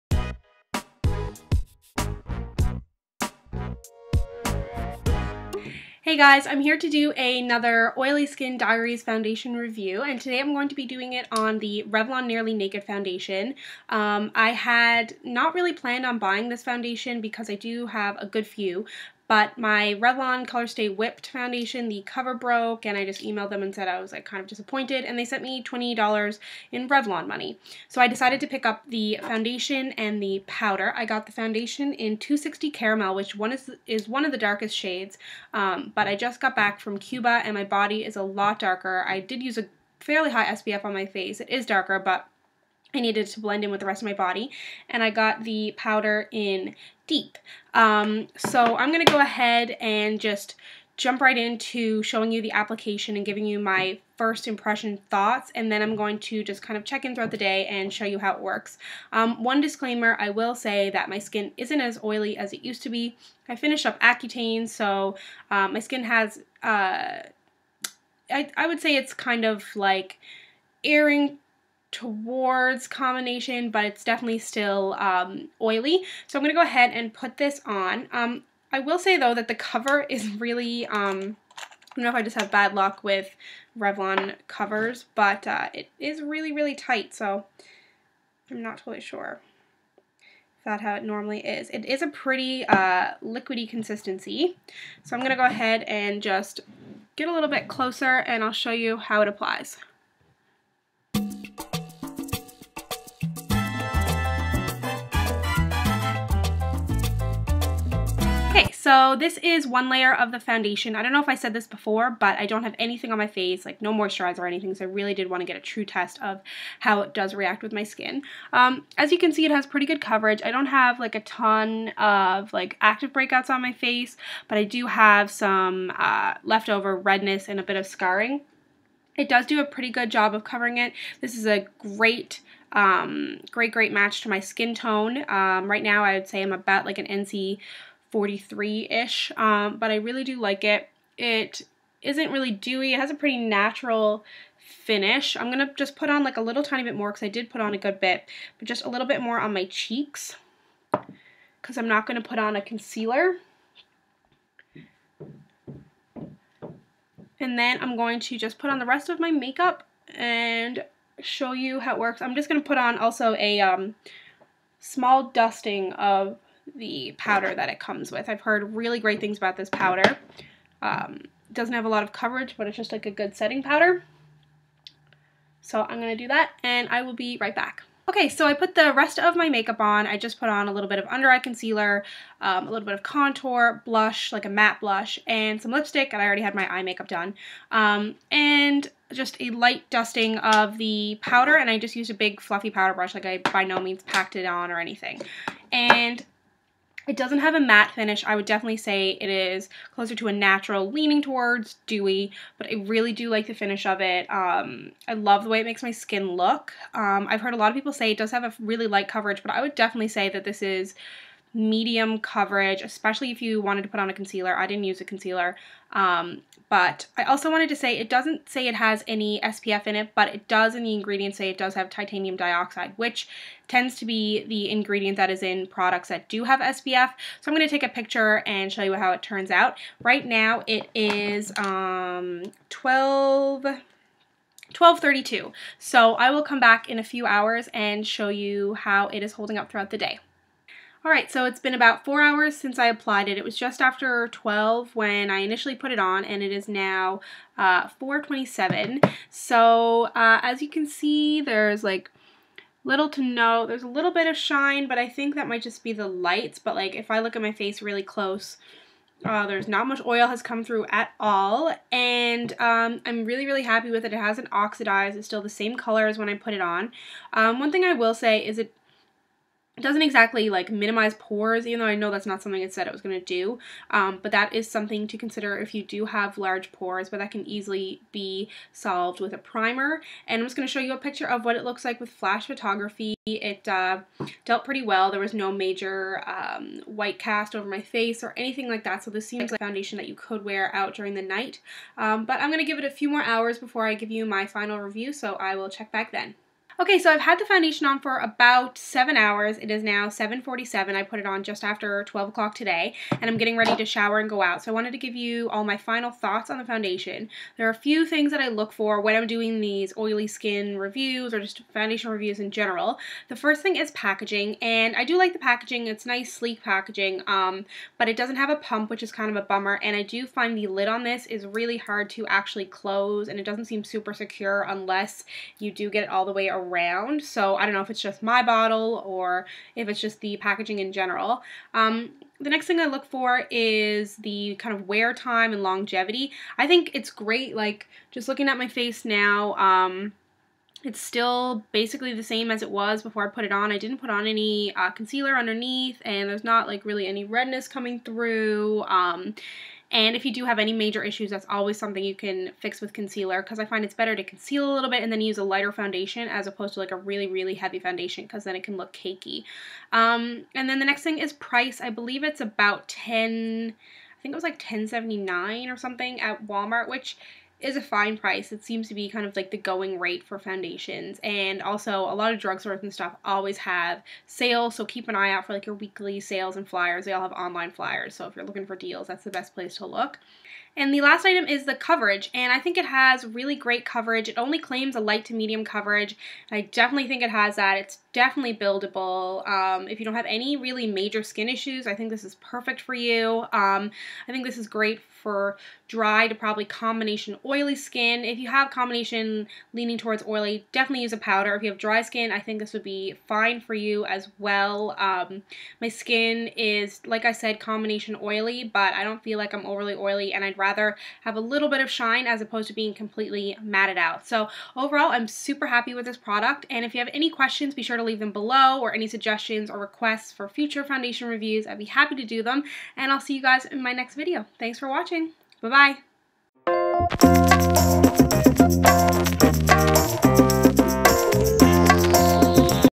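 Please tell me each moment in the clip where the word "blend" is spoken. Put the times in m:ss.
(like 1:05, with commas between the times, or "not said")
0:43.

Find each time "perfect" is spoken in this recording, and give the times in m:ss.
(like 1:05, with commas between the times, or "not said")
6:32.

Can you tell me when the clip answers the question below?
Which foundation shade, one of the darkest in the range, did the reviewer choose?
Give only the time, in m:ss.
0:32.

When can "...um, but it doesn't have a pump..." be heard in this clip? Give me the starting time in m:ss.
5:17.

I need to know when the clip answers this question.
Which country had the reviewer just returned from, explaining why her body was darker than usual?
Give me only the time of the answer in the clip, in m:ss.
0:36.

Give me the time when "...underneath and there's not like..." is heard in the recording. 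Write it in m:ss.
5:45.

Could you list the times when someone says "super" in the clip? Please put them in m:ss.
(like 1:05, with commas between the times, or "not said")
5:23, 6:55.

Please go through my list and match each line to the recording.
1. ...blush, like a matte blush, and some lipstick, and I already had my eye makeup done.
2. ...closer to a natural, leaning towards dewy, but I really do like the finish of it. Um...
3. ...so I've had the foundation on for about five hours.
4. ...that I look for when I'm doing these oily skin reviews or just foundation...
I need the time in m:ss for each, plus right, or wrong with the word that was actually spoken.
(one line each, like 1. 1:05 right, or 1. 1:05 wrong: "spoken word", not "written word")
1. 3:03 right
2. 3:19 right
3. 4:56 wrong: "seven", not "five"
4. 5:08 right.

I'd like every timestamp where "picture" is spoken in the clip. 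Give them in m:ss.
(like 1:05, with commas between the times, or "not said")
3:47, 4:40.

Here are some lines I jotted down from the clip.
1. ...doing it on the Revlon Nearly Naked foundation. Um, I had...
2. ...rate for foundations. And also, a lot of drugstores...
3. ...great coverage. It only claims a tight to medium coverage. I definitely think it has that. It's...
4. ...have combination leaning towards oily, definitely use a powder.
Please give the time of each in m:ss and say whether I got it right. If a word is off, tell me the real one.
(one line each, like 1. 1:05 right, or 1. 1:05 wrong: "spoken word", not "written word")
1. 0:10 right
2. 6:09 right
3. 6:23 wrong: "light", not "tight"
4. 6:38 right.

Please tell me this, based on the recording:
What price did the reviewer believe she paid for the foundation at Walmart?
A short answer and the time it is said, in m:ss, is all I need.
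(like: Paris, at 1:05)
10.79, at 6:04.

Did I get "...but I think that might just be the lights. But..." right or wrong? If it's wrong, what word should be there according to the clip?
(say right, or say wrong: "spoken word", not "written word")
right.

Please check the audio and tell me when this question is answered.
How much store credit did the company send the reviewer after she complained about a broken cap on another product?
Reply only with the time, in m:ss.
0:25.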